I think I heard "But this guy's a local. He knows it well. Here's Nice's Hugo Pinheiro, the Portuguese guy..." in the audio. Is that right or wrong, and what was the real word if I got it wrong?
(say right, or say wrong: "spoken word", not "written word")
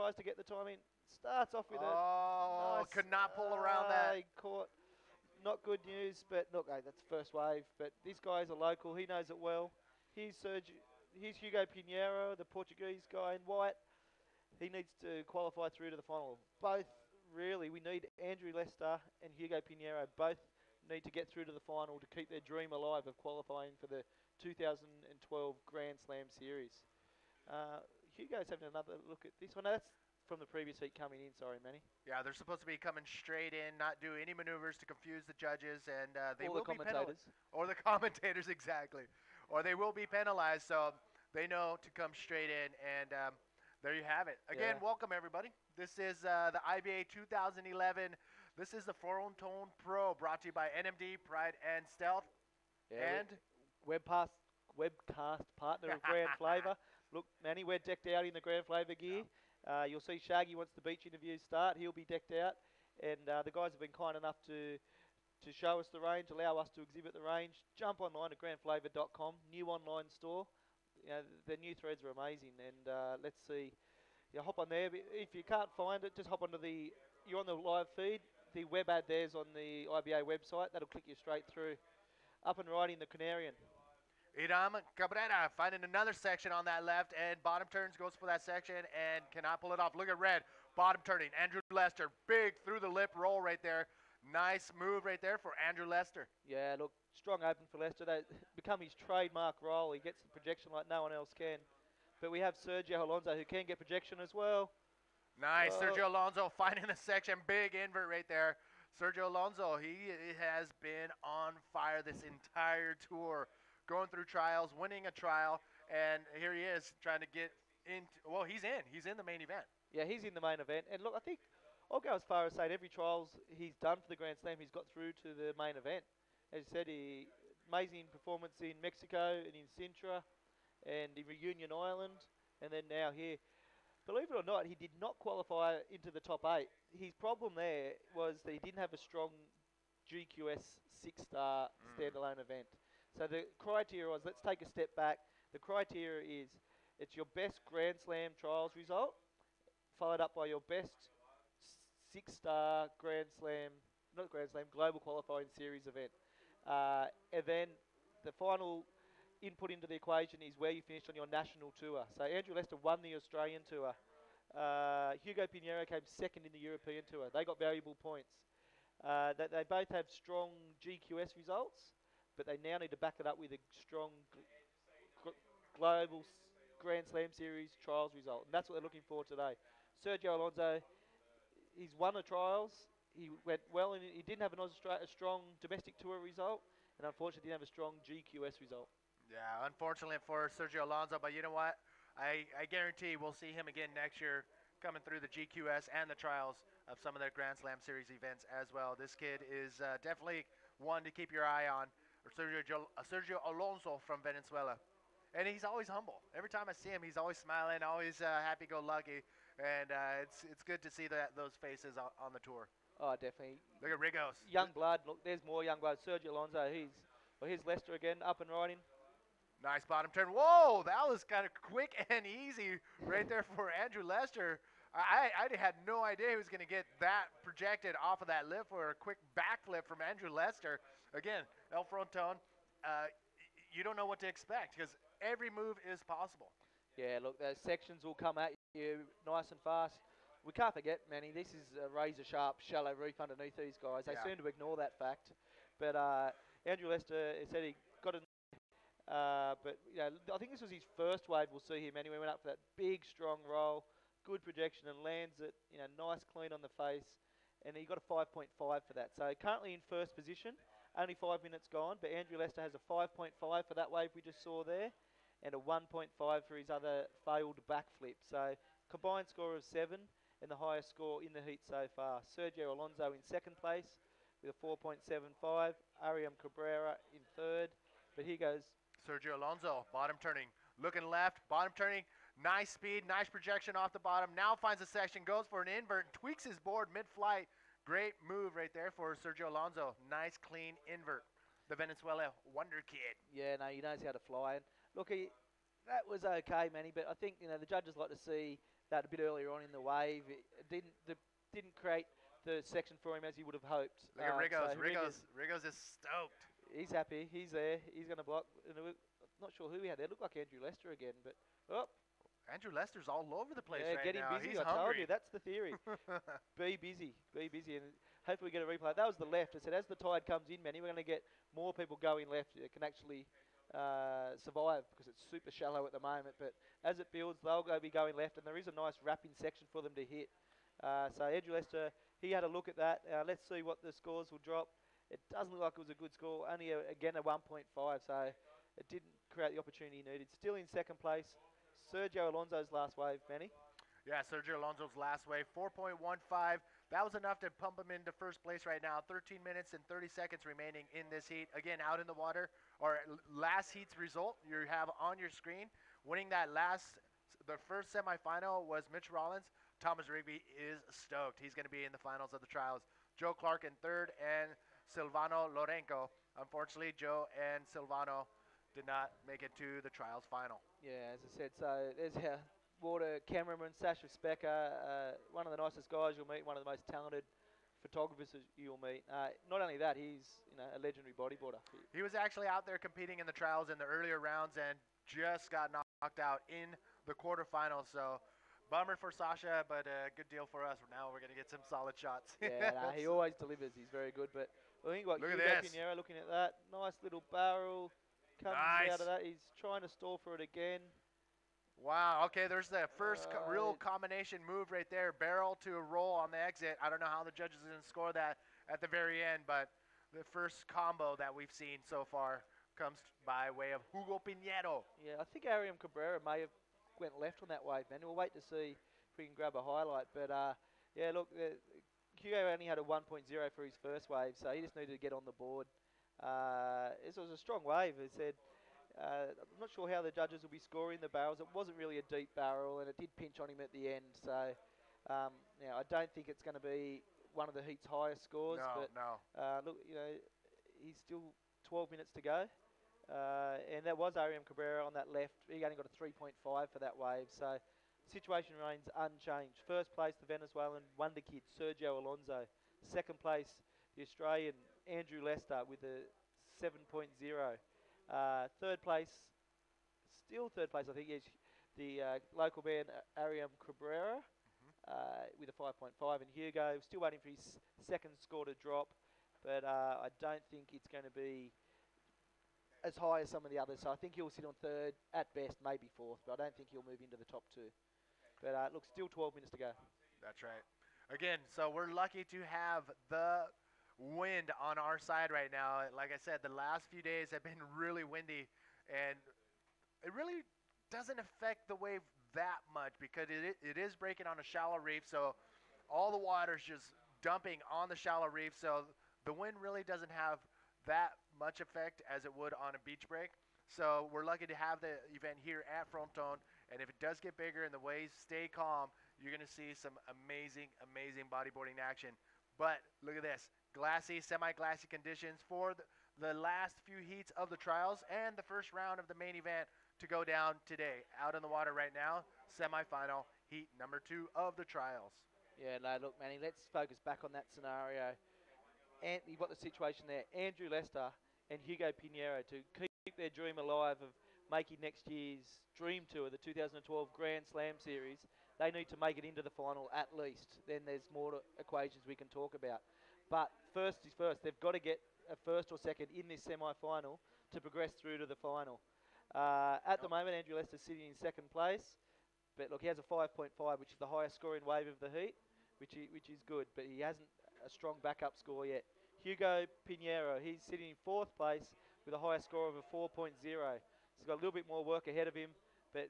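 wrong: "Here", not "Nice".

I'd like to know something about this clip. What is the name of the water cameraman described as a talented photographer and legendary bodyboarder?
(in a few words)
Sacha Specker.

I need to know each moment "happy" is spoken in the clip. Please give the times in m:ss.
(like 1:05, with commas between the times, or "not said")
3:28, 5:06.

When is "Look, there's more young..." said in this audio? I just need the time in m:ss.
3:35.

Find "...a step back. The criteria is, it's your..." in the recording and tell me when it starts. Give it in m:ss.
2:24.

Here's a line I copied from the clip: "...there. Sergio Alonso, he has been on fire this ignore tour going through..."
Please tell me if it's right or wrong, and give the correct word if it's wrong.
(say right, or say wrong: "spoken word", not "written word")
wrong: "entire", not "ignore".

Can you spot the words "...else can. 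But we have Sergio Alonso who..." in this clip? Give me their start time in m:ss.
1:41.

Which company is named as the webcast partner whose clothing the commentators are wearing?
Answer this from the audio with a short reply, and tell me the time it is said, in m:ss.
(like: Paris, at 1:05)
Grand Flavour, at 0:56.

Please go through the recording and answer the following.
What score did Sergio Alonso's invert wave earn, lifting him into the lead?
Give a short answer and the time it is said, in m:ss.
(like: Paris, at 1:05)
4.15, at 5:45.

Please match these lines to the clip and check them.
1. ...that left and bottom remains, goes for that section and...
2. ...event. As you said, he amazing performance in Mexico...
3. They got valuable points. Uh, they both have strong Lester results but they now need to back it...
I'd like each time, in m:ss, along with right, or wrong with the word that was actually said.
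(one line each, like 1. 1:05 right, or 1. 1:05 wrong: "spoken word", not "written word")
1. 1:26 wrong: "turns", not "remains"
2. 2:05 right
3. 2:47 wrong: "GQS", not "Lester".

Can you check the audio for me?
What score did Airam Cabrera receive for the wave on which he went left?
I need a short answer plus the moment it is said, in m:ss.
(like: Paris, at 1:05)
3.5, at 7:26.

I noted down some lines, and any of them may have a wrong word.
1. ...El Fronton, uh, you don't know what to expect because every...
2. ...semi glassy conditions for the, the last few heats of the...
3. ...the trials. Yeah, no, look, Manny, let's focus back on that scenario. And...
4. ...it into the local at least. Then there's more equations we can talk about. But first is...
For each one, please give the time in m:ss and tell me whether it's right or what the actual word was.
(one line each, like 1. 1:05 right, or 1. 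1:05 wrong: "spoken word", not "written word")
1. 3:51 right
2. 8:34 right
3. 8:44 right
4. 8:59 wrong: "final", not "local".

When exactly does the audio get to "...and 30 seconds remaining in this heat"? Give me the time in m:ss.
5:49.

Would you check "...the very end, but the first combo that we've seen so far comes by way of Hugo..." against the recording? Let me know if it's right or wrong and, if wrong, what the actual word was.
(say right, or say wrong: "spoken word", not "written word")
right.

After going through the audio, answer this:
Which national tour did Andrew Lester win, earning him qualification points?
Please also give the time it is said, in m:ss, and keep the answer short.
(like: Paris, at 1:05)
Australian tour, at 2:43.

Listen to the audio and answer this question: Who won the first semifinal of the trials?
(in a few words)
Mitch Rawlins.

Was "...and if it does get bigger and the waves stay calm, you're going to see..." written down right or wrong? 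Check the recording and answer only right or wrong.
right.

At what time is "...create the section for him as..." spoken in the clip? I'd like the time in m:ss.
5:01.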